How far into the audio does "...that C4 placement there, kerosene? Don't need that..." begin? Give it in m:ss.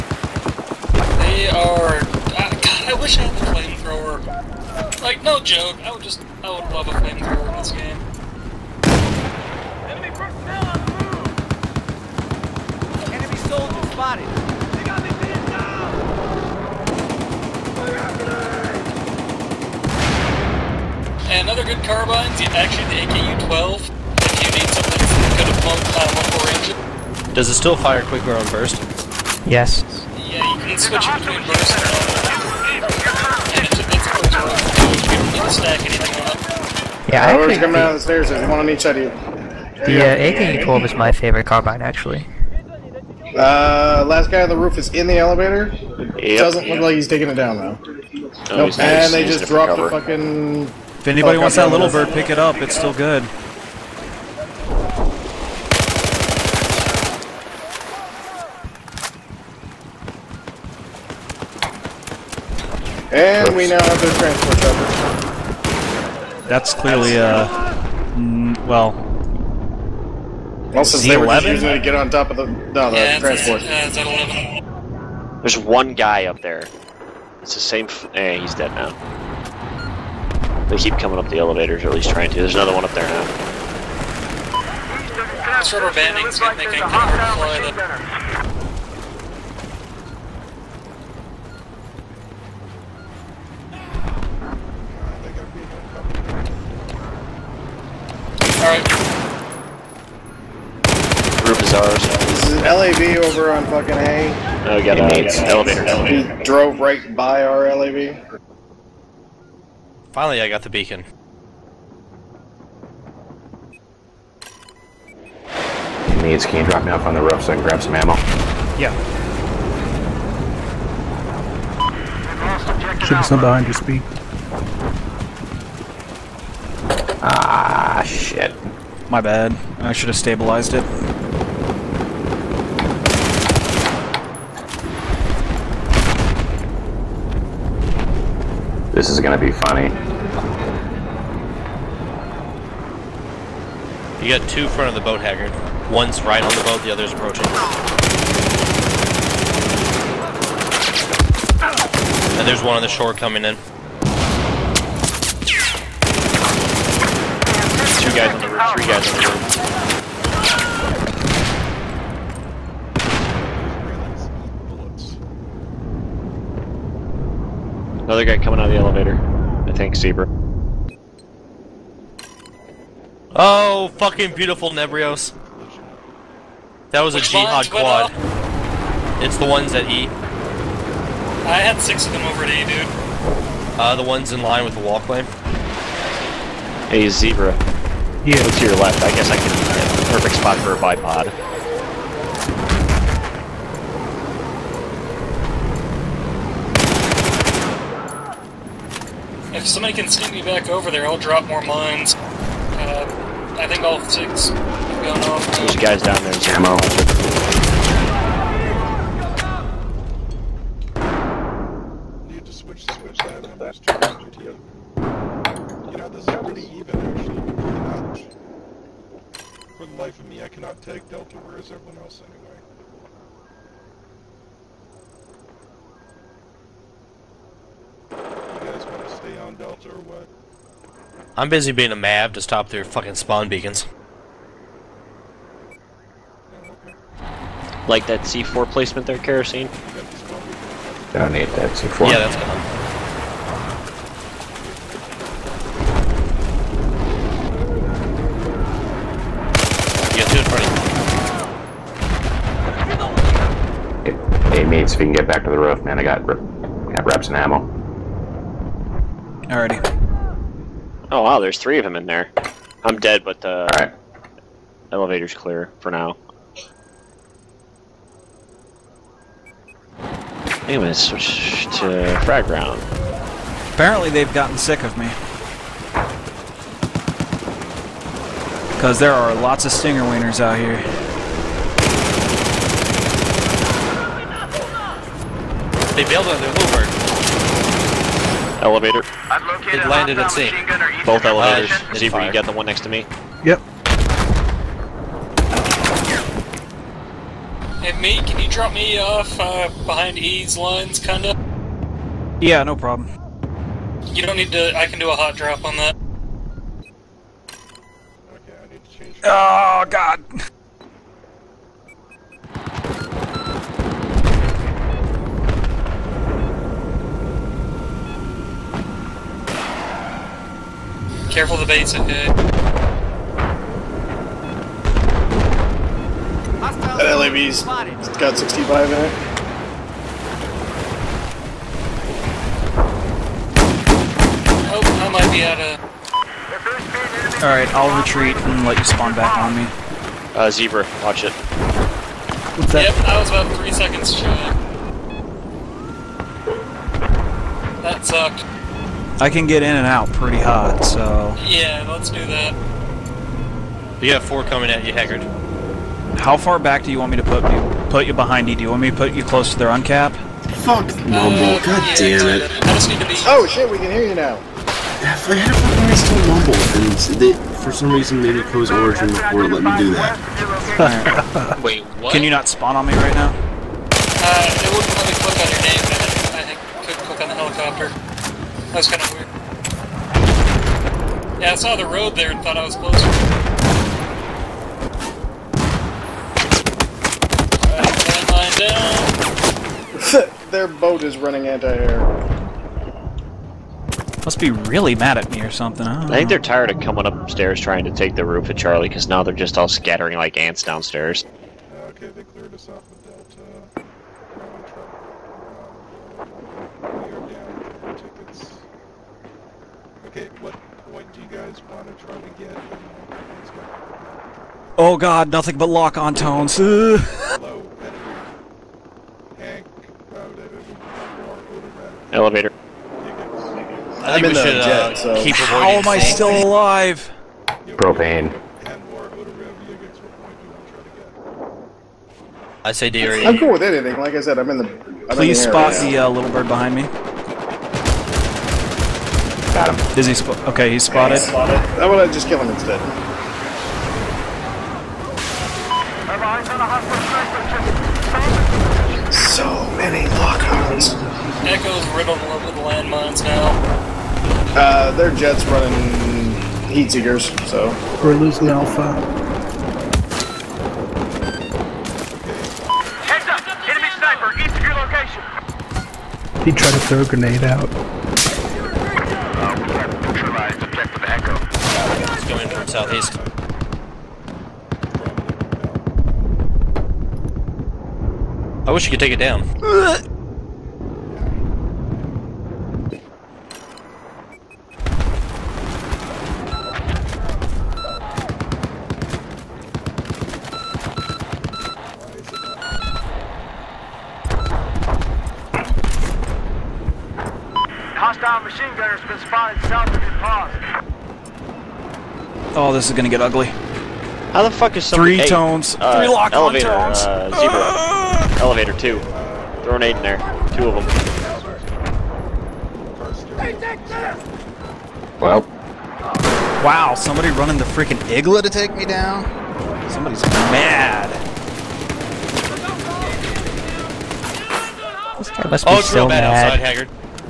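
3:58.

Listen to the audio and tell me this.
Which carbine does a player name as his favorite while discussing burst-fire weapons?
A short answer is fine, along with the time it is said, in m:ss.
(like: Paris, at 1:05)
AK-12, at 0:40.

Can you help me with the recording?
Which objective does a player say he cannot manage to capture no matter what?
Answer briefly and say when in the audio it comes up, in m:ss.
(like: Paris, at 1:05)
Delta, at 3:41.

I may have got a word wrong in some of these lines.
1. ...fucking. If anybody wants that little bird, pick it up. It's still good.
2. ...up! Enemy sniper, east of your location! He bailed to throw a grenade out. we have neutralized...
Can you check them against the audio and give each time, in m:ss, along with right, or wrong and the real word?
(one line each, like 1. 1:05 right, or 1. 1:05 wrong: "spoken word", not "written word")
1. 0:49 right
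2. 7:43 wrong: "tried", not "bailed".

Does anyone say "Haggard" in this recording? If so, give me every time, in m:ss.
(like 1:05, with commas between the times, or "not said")
2:25, 5:54, 8:46.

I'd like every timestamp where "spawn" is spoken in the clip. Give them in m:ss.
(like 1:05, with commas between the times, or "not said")
3:53, 5:38, 6:12.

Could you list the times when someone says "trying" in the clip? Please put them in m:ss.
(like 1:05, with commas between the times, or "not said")
1:22, 6:37.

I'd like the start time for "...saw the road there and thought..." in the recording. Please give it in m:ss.
6:21.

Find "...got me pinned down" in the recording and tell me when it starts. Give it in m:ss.
0:14.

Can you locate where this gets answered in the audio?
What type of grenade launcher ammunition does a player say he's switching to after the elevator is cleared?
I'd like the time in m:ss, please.
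4:32.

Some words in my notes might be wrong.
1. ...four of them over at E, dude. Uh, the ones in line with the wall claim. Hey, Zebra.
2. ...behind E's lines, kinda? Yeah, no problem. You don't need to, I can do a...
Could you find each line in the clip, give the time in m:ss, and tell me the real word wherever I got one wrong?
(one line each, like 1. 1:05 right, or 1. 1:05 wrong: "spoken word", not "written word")
1. 3:01 wrong: "six", not "four"
2. 4:59 right.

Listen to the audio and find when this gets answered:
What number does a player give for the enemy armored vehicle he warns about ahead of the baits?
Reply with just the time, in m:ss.
5:28.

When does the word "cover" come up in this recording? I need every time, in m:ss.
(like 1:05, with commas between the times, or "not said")
0:49, 1:04.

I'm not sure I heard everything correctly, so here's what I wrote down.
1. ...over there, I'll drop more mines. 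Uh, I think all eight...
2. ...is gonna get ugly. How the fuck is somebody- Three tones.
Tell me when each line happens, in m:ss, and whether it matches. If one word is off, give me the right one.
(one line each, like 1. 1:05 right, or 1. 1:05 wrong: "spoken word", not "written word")
1. 3:20 wrong: "six", not "eight"
2. 8:22 right.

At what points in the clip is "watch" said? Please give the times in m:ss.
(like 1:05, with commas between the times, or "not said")
5:41.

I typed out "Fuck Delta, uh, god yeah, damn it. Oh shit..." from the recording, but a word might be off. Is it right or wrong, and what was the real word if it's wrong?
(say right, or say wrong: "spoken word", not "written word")
wrong: "Mumble", not "Delta".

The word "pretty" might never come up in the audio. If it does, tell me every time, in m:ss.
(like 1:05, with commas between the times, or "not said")
3:36, 5:50.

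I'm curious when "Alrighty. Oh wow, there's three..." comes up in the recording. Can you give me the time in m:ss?
4:19.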